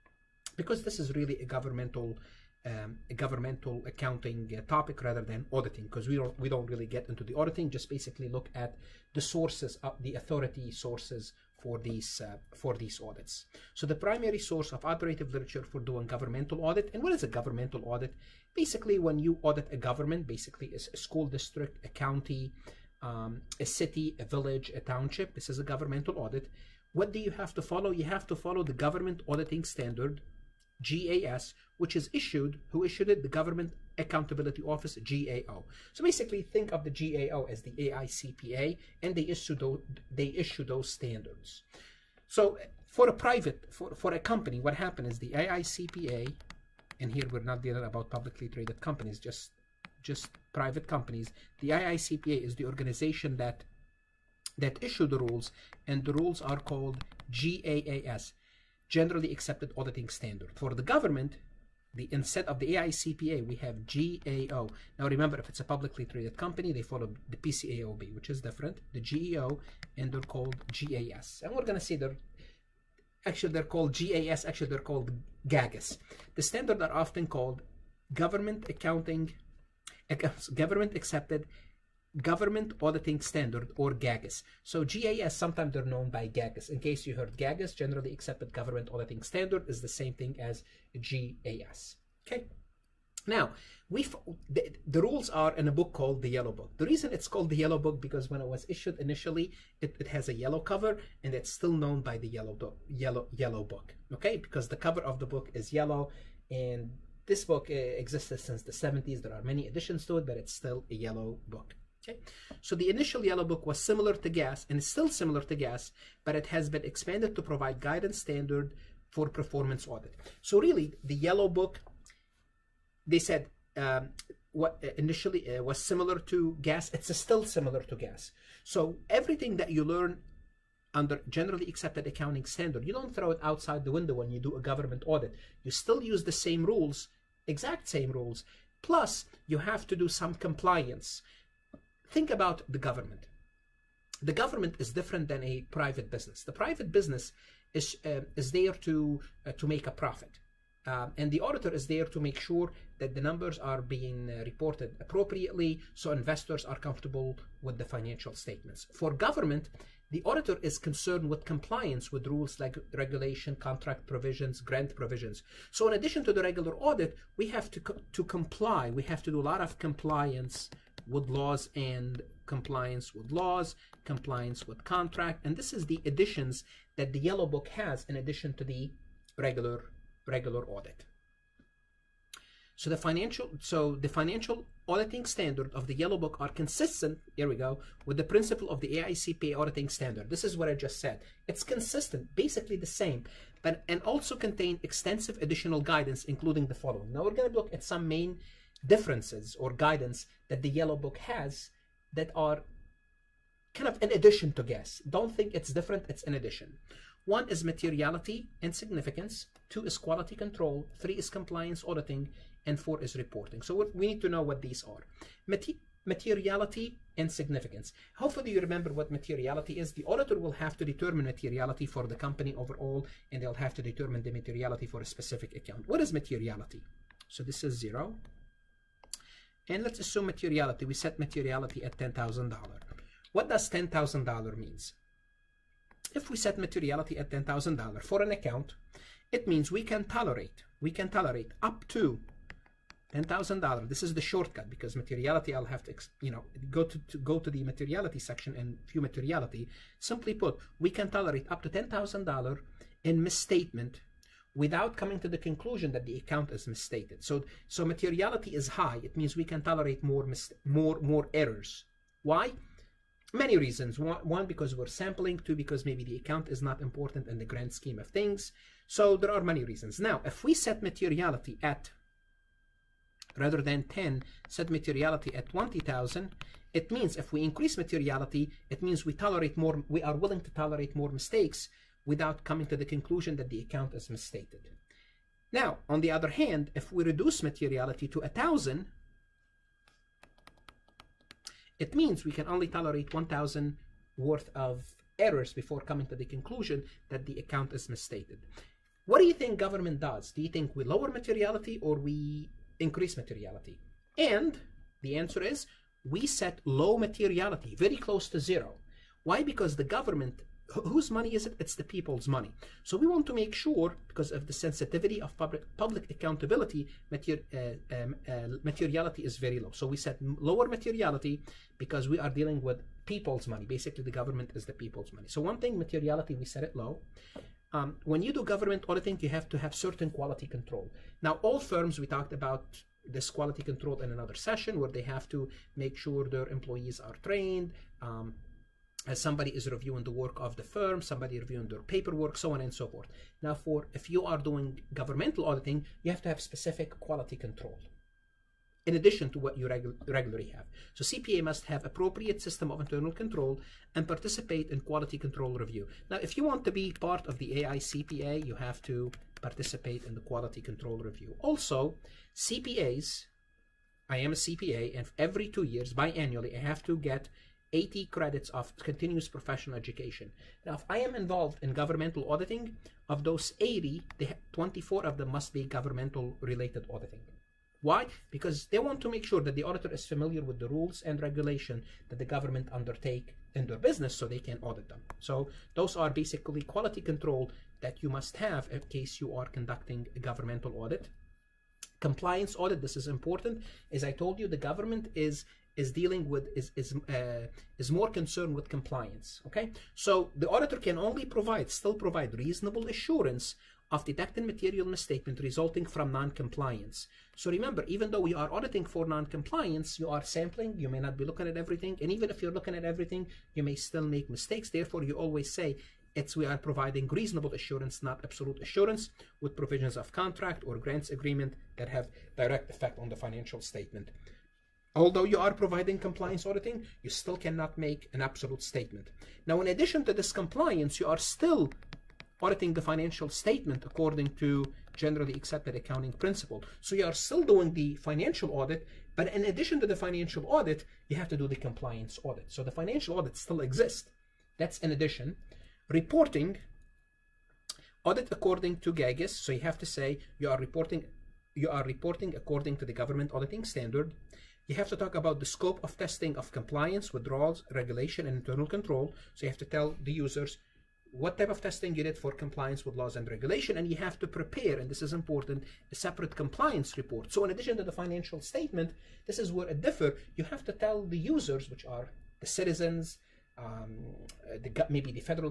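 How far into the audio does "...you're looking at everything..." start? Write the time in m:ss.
6:52.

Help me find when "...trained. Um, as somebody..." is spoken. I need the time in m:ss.
5:37.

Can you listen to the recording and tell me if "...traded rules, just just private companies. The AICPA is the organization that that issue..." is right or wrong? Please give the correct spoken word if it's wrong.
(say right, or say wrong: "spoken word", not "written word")
wrong: "companies", not "rules".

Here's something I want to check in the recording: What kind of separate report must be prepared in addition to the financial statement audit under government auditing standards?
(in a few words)
compliance report.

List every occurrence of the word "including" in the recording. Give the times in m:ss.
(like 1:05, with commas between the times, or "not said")
3:16.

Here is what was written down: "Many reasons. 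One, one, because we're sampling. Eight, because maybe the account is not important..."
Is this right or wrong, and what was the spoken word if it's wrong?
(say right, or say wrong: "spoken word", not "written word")
wrong: "Two", not "Eight".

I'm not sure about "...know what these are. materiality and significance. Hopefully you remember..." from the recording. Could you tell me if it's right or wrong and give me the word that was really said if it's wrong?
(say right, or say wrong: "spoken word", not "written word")
right.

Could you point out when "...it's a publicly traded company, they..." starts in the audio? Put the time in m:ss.
1:05.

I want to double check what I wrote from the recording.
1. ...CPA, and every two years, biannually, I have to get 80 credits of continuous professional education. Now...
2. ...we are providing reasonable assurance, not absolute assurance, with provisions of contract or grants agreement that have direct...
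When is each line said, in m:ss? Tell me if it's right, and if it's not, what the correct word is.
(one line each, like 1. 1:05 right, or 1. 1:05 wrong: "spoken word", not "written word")
1. 6:04 right
2. 6:56 right.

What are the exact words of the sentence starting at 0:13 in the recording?
So the primary source of operative literature for doing governmental audit, and what is a governmental audit?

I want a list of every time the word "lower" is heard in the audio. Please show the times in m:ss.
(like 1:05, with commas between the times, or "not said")
5:00, 5:20.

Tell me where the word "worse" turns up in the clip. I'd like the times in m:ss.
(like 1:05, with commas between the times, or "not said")
not said.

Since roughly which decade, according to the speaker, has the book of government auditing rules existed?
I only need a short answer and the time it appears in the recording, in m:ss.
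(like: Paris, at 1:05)
the 70s, at 1:48.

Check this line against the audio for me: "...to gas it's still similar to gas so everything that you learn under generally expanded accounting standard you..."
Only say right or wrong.
wrong.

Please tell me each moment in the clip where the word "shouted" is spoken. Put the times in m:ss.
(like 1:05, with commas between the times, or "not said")
not said.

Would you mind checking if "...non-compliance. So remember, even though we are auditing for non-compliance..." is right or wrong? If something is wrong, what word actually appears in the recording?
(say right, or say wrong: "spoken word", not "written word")
right.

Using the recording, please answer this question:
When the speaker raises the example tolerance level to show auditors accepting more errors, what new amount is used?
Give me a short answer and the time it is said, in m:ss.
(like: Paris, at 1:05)
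20,000, at 4:35.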